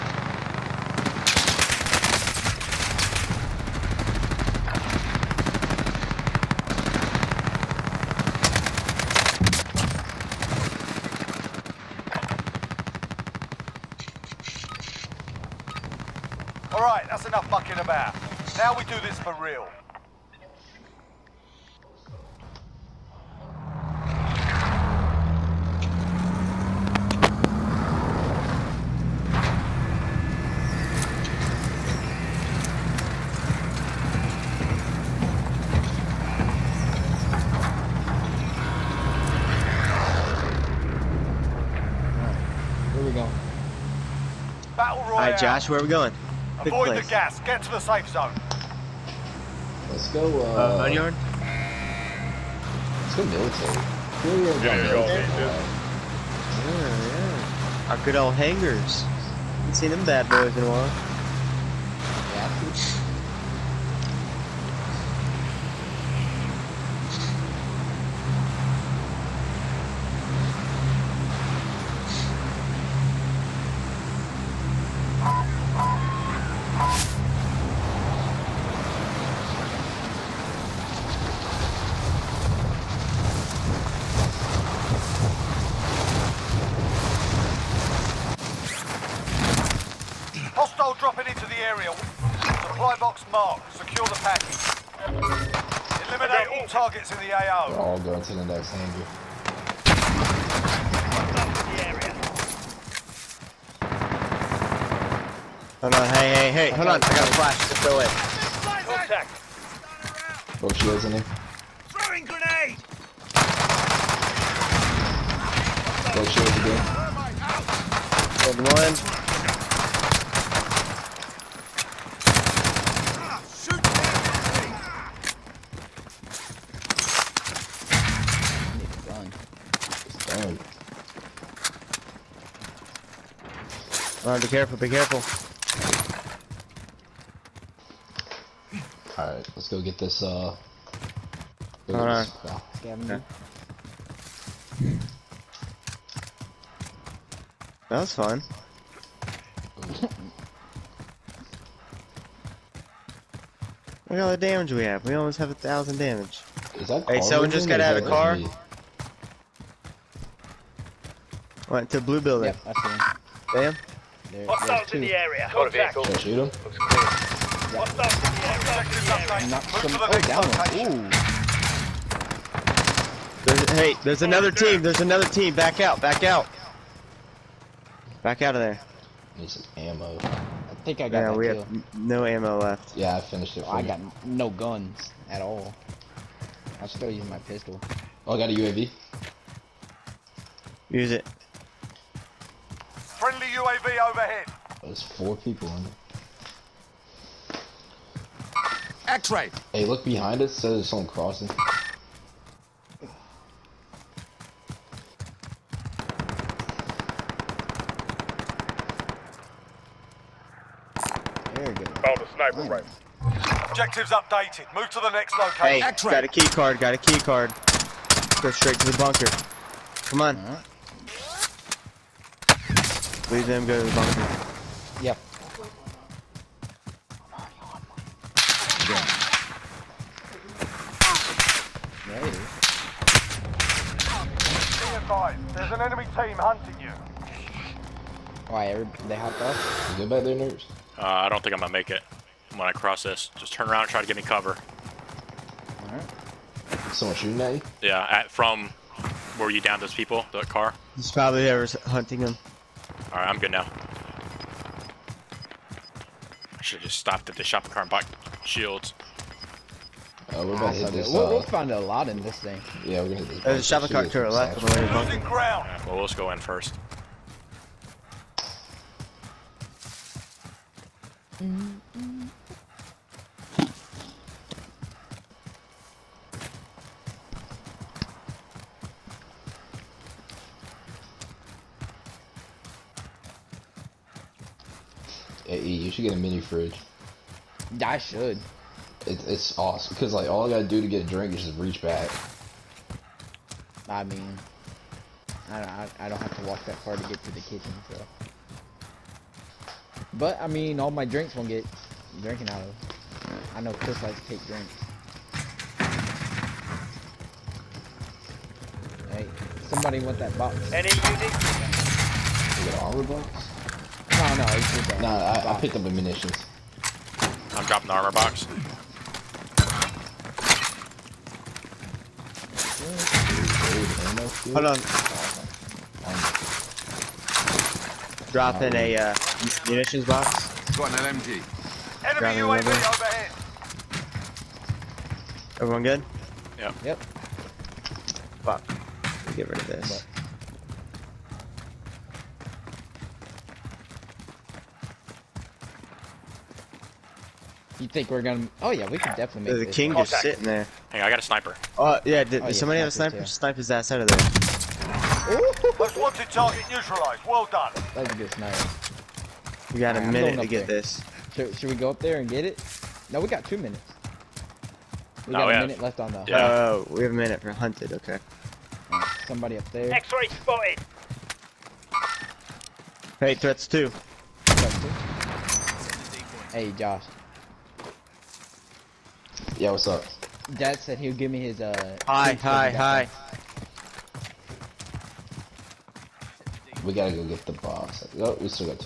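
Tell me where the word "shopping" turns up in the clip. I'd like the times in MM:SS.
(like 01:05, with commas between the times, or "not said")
04:17, 04:23.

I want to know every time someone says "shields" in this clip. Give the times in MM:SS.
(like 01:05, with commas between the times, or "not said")
01:50, 01:56, 04:18.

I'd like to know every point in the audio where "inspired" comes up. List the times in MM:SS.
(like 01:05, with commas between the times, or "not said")
not said.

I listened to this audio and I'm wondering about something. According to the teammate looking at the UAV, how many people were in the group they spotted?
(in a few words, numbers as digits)
Four.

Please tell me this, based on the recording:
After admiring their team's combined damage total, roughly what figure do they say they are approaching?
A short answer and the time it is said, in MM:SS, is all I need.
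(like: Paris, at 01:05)
A thousand, at 02:35.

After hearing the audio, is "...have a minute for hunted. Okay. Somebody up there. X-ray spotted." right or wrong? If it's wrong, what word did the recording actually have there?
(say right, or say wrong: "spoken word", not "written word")
right.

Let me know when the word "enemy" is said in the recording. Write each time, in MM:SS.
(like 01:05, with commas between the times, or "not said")
03:55, 05:32.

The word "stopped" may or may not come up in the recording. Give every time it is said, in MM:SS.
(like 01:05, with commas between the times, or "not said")
04:16.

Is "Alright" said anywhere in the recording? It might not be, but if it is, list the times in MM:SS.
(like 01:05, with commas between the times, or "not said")
02:19, 04:05, 04:13.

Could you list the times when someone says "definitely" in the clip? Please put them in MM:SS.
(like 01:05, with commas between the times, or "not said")
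05:49.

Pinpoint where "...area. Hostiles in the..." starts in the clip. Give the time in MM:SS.
02:49.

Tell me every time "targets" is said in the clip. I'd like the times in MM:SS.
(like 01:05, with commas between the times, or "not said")
01:36, 05:56.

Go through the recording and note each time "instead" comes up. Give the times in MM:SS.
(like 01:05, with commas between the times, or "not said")
not said.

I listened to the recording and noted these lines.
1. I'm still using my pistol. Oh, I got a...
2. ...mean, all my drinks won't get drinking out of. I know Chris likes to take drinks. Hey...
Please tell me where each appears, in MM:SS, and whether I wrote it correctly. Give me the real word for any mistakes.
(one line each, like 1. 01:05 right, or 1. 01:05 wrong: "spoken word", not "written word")
1. 03:06 right
2. 05:00 right.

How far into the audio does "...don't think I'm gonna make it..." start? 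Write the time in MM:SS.
04:01.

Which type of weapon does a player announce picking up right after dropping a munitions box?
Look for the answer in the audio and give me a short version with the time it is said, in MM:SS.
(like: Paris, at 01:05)
An LMG, at 05:30.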